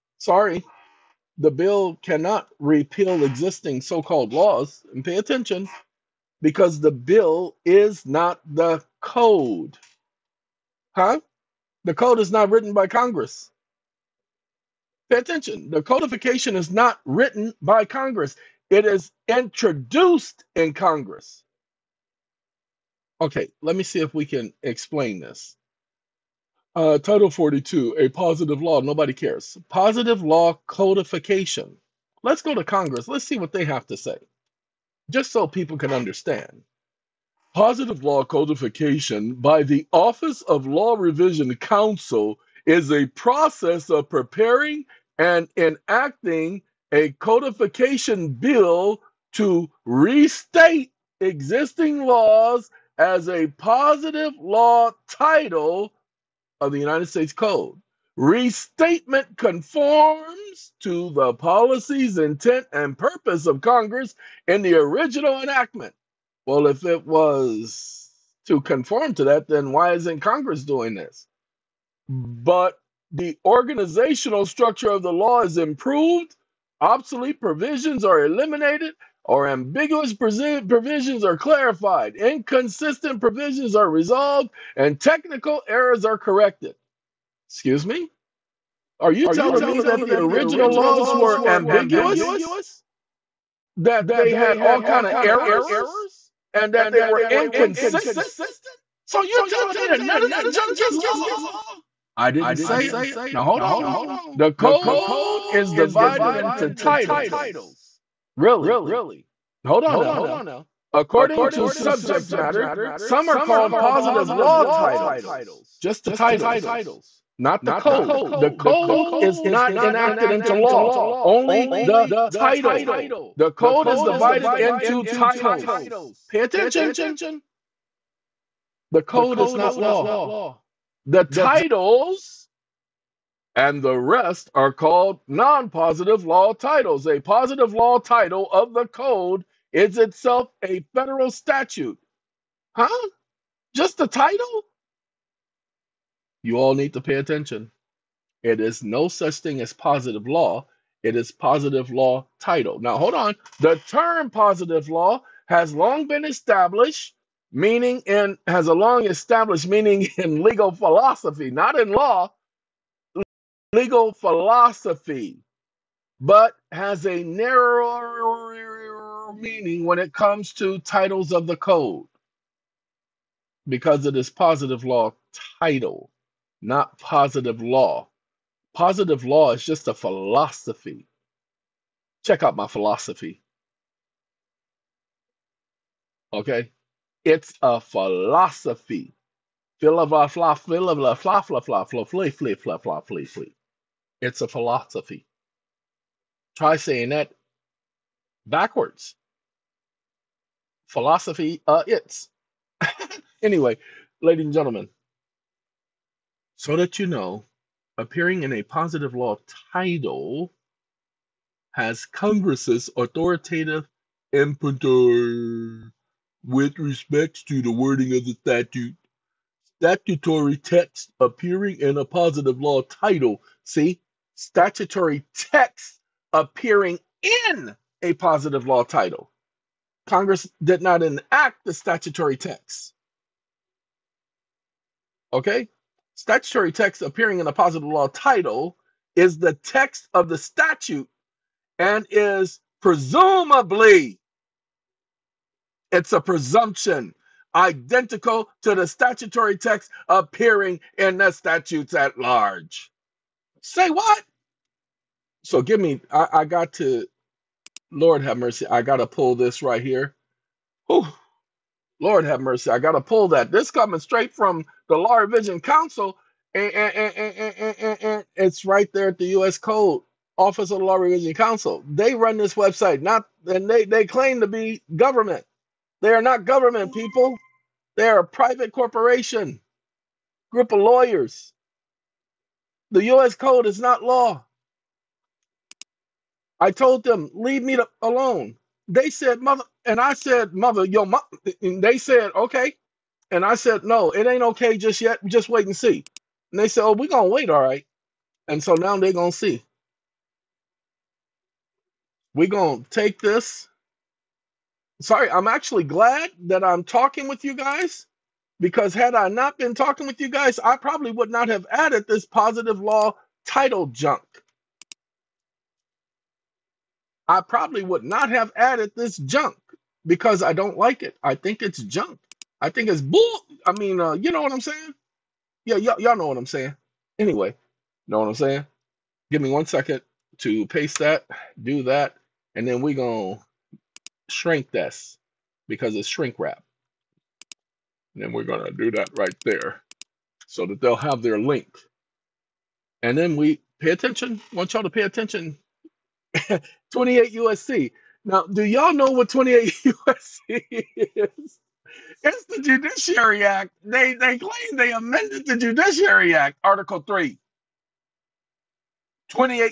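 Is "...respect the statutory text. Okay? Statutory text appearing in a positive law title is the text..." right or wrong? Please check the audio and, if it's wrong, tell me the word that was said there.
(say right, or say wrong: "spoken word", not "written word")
wrong: "enact", not "respect".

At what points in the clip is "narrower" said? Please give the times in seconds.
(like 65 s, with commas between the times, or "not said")
167 s.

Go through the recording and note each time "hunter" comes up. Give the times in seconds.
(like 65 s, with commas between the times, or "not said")
not said.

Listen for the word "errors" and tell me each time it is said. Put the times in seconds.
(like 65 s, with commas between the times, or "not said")
85 s, 95 s.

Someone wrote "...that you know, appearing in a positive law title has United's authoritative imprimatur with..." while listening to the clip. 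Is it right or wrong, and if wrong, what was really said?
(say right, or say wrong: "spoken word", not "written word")
wrong: "Congress", not "United".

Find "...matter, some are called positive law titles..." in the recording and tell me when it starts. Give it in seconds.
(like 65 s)
112 s.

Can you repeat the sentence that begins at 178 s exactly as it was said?
Positive law is just a philosophy.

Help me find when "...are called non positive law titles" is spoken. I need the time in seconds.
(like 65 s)
134 s.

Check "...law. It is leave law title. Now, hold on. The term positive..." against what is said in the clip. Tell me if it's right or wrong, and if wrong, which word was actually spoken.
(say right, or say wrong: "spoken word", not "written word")
wrong: "positive", not "leave".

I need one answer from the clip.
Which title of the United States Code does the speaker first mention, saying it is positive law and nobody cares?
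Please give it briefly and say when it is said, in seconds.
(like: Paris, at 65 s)
Title 42, at 26 s.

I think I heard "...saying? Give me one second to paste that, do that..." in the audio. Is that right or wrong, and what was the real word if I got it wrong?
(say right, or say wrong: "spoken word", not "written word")
right.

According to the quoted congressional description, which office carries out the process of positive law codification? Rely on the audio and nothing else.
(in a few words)
Office of Law Revision Council.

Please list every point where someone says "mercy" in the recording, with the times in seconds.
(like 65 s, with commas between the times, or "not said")
258 s, 262 s.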